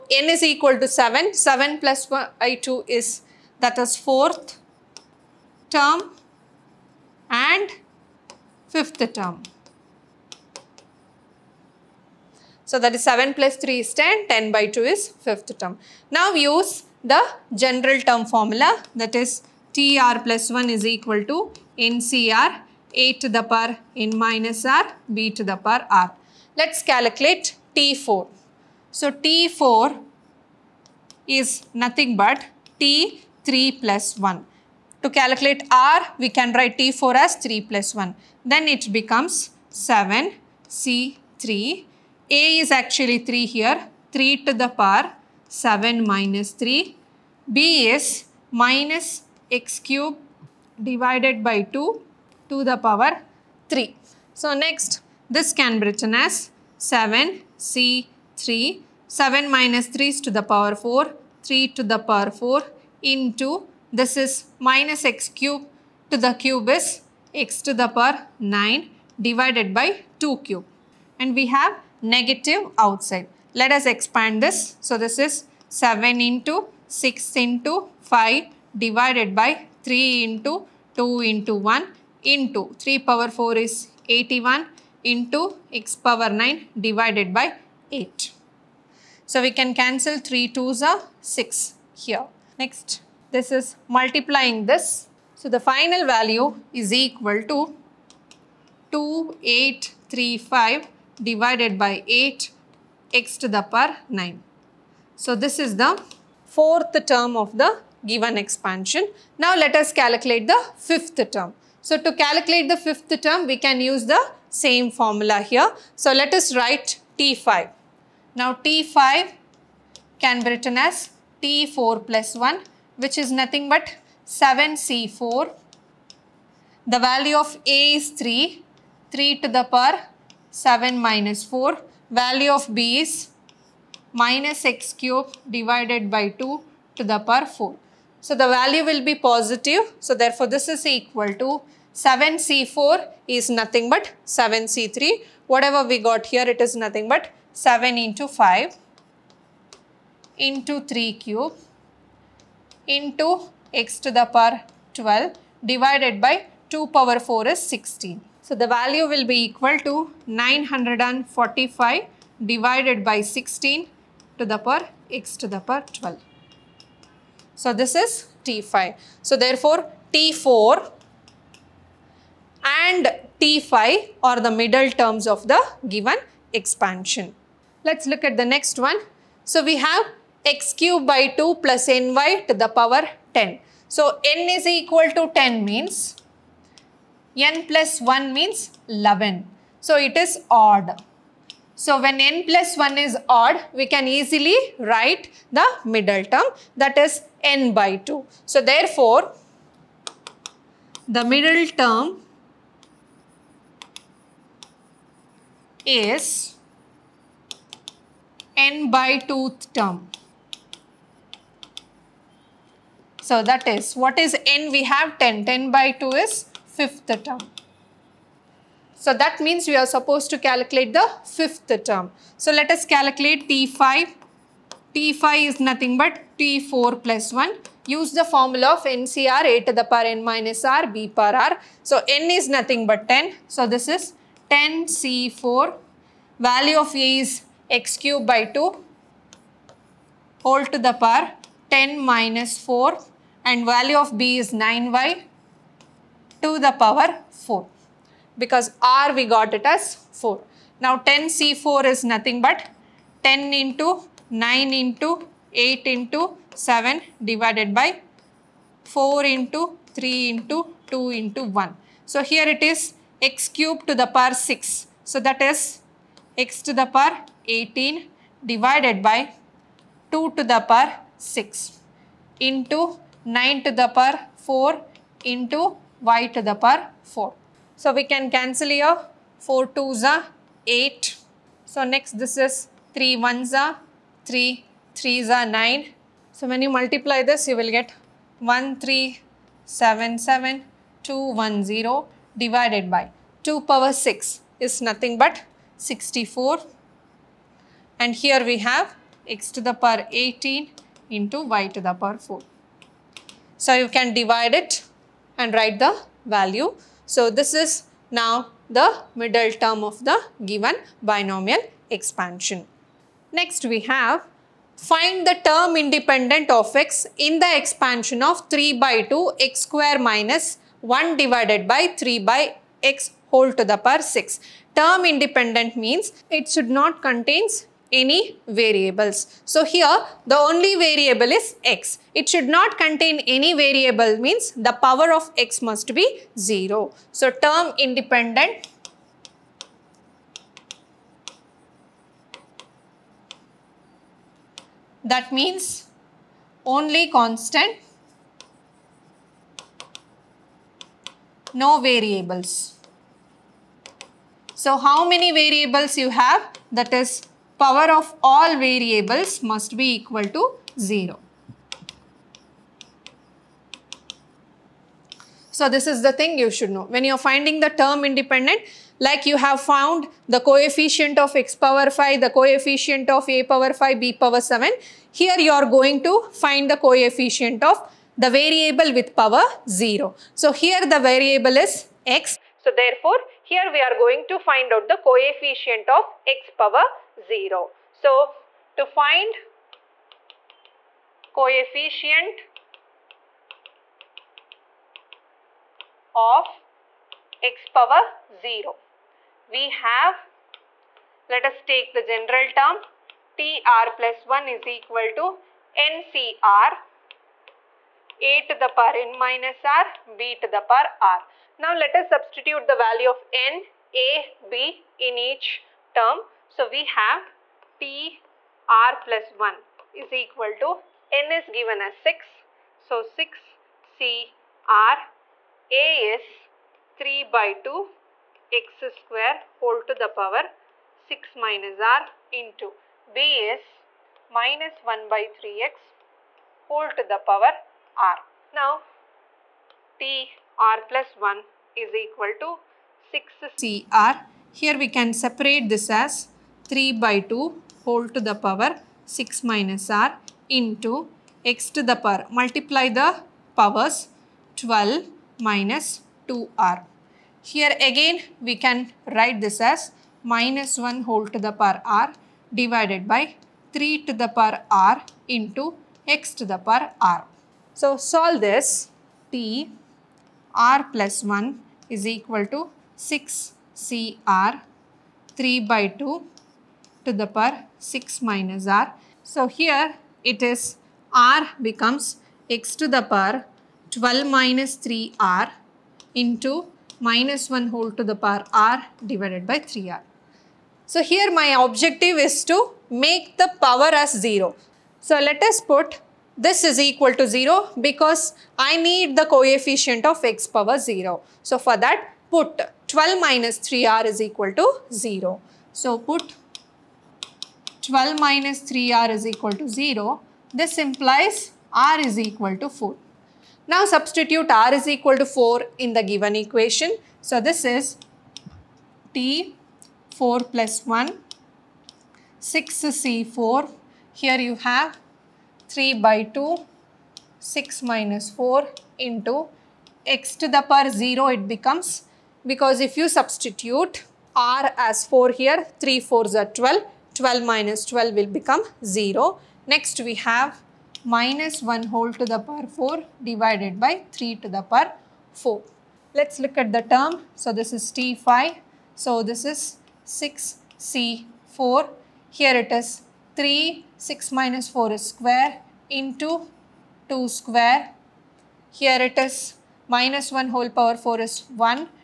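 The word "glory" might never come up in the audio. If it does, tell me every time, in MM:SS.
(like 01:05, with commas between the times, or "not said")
not said.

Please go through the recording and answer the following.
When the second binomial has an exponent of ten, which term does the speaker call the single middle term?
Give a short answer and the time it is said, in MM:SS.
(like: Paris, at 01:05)
5th term, at 03:36.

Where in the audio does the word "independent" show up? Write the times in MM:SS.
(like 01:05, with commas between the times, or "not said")
05:15, 05:25, 05:37, 06:08.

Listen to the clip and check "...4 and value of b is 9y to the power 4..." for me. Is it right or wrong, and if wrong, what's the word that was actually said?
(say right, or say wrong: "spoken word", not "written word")
right.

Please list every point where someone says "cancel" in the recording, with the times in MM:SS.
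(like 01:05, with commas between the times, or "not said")
01:29, 04:38.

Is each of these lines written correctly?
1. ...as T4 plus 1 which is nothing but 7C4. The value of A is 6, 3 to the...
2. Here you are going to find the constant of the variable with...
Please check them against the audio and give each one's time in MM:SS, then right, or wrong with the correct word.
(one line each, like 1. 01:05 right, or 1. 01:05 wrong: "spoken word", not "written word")
1. 02:00 wrong: "3", not "6"
2. 06:15 wrong: "coefficient", not "constant".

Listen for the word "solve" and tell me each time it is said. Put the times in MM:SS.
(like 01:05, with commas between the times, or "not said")
07:47.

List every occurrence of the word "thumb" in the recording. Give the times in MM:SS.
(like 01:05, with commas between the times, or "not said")
not said.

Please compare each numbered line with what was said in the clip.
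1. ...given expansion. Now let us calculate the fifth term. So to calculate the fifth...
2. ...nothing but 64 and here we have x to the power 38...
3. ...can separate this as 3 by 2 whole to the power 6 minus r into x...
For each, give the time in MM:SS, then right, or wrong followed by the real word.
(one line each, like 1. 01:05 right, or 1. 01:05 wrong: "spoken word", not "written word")
1. 01:48 right
2. 04:54 wrong: "18", not "38"
3. 07:24 right.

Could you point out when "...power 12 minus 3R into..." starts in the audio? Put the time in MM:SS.
08:03.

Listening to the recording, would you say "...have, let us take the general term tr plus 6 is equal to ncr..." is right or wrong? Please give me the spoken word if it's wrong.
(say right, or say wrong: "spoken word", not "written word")
wrong: "1", not "6".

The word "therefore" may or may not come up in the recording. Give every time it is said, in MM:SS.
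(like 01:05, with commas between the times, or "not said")
02:20, 02:49, 03:18, 06:22.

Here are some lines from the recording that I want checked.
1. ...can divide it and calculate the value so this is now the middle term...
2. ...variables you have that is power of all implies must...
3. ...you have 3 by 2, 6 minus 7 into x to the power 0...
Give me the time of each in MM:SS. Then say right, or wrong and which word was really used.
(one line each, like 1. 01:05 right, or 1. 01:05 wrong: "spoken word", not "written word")
1. 05:03 wrong: "write", not "calculate"
2. 05:55 wrong: "variables", not "implies"
3. 08:44 wrong: "4", not "7".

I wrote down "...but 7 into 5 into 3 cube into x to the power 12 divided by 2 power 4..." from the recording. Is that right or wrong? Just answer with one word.
right.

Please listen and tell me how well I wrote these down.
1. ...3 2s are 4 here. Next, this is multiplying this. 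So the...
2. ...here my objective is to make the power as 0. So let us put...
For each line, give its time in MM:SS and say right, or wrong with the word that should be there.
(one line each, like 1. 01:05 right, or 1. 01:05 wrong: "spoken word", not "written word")
1. 01:30 wrong: "6", not "4"
2. 08:11 right.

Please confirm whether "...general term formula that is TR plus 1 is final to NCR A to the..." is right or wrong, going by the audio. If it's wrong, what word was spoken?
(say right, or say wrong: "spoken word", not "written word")
wrong: "equal", not "final".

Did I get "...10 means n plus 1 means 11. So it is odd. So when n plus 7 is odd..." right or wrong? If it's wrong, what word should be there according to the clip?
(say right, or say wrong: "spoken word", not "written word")
wrong: "1", not "7".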